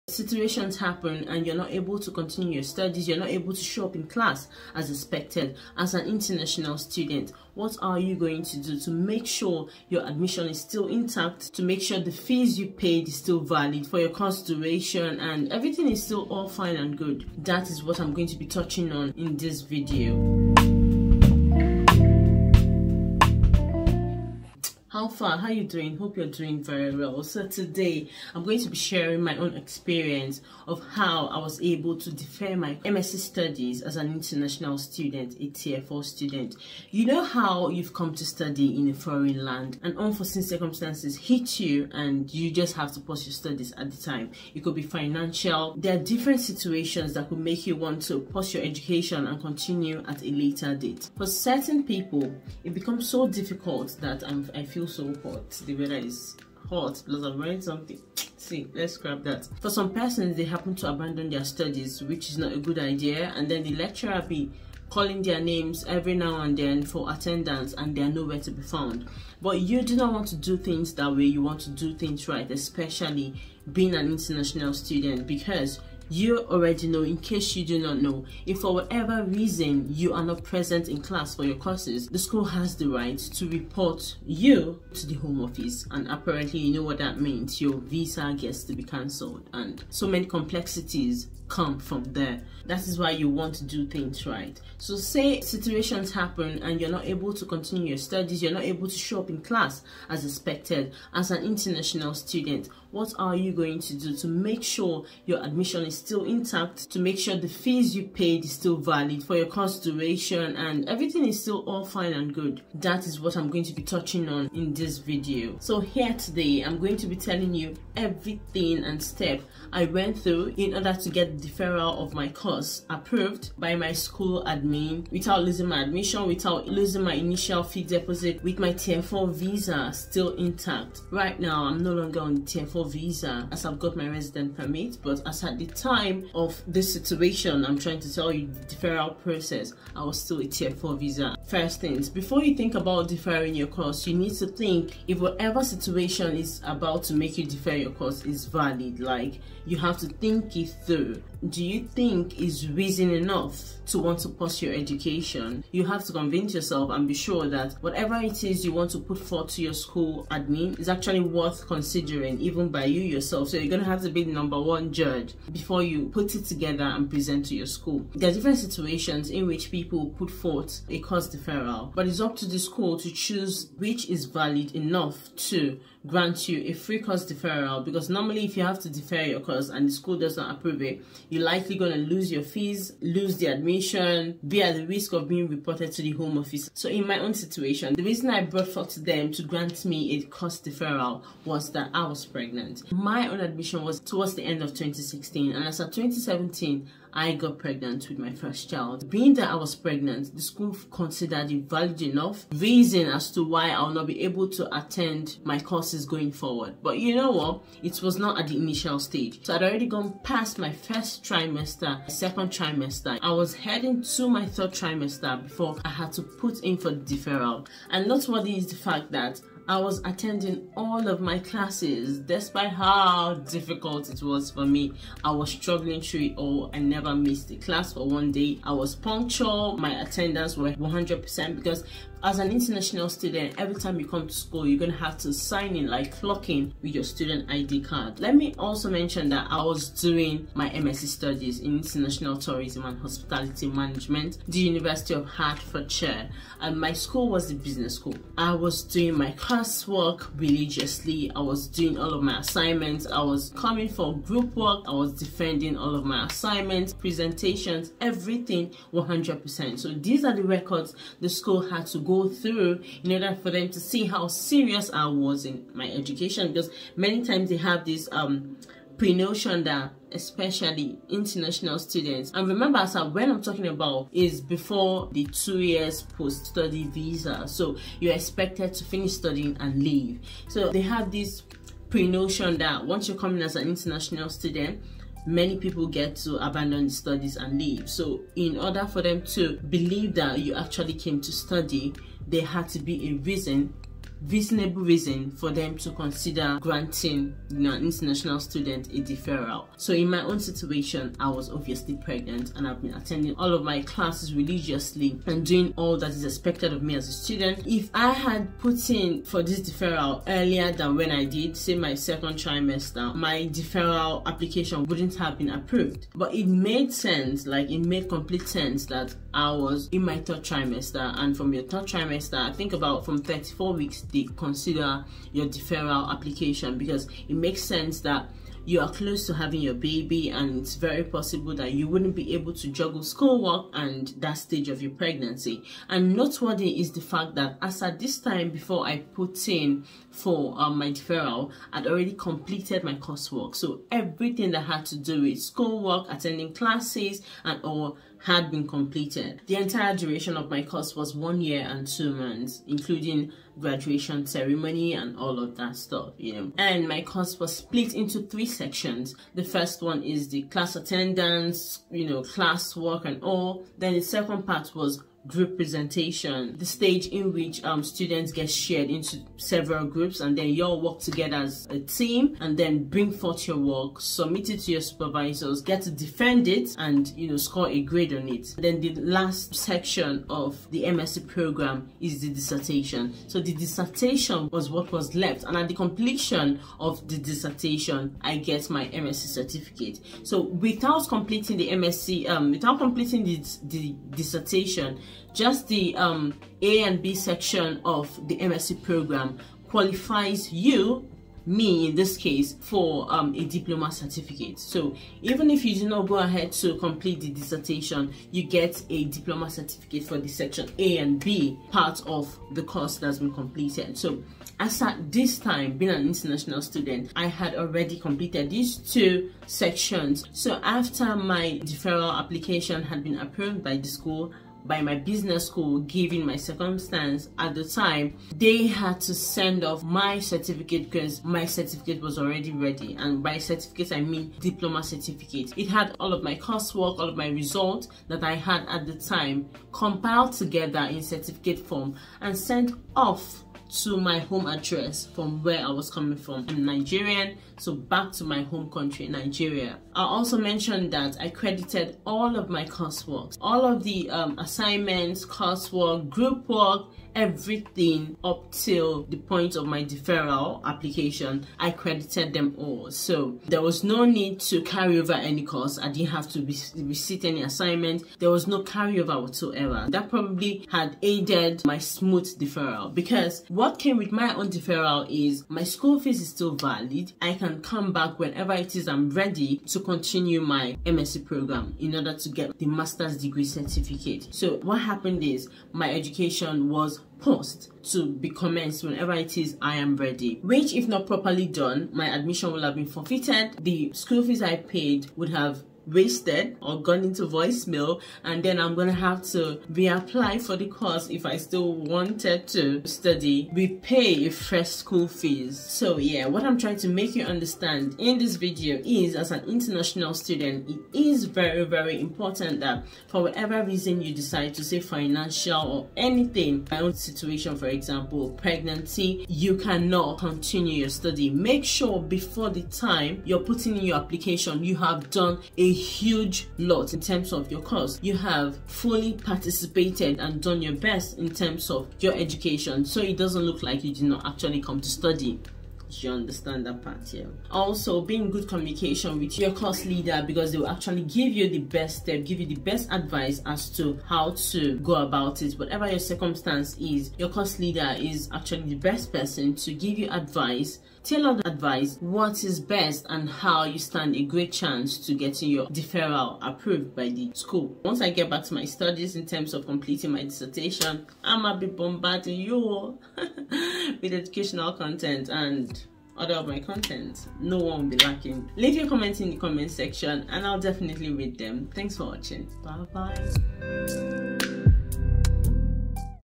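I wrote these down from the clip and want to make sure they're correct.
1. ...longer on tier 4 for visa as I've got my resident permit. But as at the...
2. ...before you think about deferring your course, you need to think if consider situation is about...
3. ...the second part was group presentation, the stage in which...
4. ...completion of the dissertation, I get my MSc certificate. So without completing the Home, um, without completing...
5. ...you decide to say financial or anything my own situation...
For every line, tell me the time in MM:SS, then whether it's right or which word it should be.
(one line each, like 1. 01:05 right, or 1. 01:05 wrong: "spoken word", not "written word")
1. 02:11 right
2. 02:22 wrong: "whatever", not "consider"
3. 06:03 right
4. 06:25 wrong: "MSc", not "Home"
5. 08:34 right.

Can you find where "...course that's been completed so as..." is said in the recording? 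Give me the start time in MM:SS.
06:52.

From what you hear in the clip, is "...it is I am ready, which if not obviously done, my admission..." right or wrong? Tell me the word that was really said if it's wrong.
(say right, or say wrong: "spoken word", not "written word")
wrong: "properly", not "obviously".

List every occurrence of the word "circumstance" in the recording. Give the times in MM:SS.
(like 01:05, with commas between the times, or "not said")
00:40, 07:06, 09:05.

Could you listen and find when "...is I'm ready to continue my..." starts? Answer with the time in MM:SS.
07:58.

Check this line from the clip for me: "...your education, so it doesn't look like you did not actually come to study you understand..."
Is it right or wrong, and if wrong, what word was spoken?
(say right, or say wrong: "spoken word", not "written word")
right.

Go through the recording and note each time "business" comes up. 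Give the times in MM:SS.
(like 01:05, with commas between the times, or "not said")
04:07, 07:04.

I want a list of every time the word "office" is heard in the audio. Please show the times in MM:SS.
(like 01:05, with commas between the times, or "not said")
01:25, 03:06.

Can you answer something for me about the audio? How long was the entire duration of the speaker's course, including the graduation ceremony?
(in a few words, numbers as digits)
One year and two months.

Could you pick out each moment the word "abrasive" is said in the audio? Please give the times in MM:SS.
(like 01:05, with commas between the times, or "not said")
not said.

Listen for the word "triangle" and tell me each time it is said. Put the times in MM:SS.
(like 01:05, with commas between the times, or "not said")
not said.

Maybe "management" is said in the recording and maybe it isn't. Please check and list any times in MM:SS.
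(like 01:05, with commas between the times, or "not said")
04:03.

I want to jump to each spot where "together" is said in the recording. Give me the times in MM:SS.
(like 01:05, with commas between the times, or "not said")
02:46, 06:10, 07:20.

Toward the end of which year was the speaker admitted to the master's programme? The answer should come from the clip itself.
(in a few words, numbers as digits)
2016.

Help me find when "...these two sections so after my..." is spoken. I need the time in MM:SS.
06:58.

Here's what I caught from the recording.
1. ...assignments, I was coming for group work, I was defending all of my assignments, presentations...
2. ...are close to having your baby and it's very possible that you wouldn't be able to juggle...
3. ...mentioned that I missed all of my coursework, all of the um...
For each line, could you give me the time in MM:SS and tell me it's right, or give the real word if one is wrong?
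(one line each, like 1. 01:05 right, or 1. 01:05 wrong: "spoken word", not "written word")
1. 04:12 right
2. 05:28 right
3. 07:30 wrong: "credited", not "missed".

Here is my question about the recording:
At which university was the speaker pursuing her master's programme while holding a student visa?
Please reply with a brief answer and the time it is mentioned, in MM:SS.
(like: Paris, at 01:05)
University of Hertfordshire, at 04:04.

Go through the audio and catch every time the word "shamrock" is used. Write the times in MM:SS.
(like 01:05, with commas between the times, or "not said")
not said.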